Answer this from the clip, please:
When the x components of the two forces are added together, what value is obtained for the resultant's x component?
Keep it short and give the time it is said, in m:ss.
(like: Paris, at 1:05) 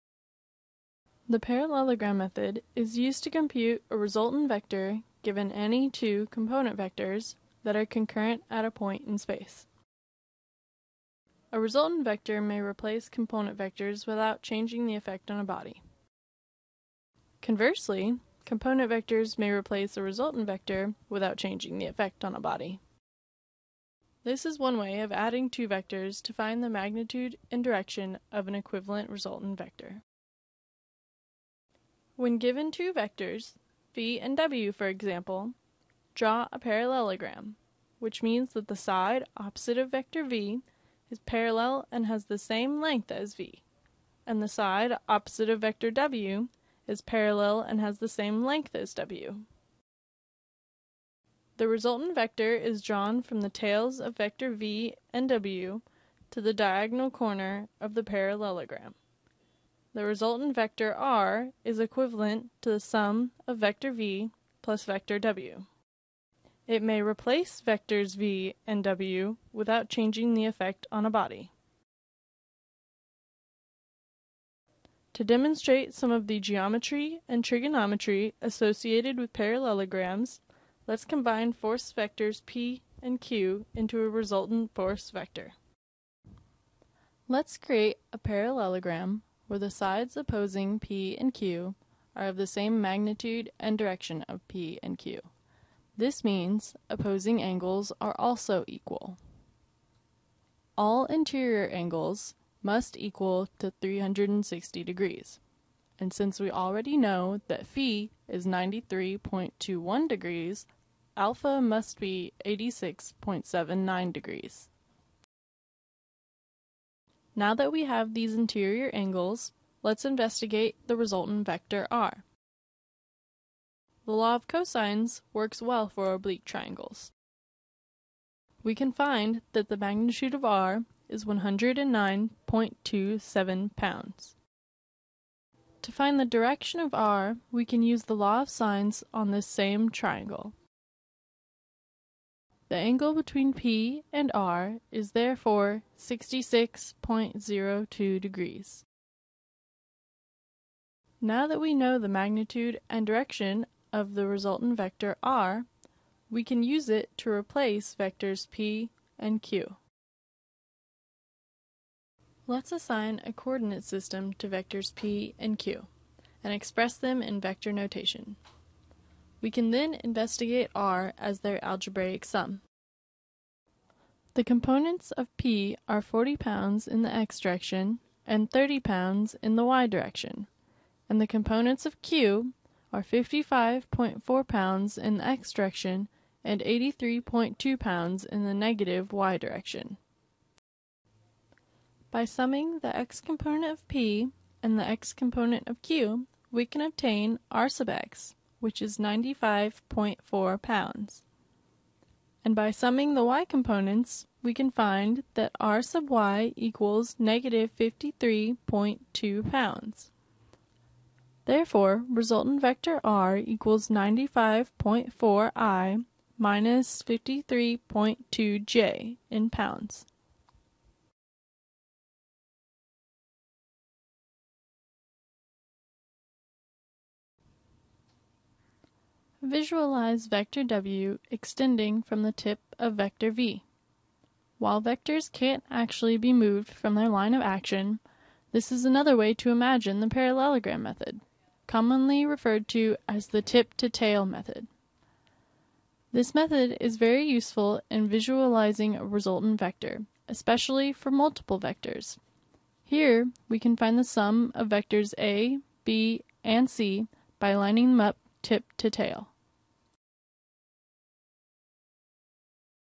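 95.4 pounds, at 3:18.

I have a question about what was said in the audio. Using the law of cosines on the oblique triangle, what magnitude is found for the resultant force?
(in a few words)
109.27 pounds.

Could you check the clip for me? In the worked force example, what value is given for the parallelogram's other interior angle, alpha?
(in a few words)
86.79 degrees.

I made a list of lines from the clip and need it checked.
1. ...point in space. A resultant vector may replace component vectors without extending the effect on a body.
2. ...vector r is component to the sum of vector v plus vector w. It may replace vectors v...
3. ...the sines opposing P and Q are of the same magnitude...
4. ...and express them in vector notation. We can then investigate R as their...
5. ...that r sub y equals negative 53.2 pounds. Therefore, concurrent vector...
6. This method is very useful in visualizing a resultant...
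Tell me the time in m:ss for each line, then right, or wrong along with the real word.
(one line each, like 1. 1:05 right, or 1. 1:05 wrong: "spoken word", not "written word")
1. 0:08 wrong: "changing", not "extending"
2. 1:00 wrong: "equivalent", not "component"
3. 1:29 wrong: "sides", not "sines"
4. 2:46 right
5. 3:25 wrong: "resultant", not "concurrent"
6. 4:06 right.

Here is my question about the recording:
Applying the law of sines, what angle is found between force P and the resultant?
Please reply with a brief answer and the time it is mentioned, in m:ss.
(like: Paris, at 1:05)
66.02 degrees, at 2:25.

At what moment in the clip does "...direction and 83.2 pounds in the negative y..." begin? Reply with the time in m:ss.
3:05.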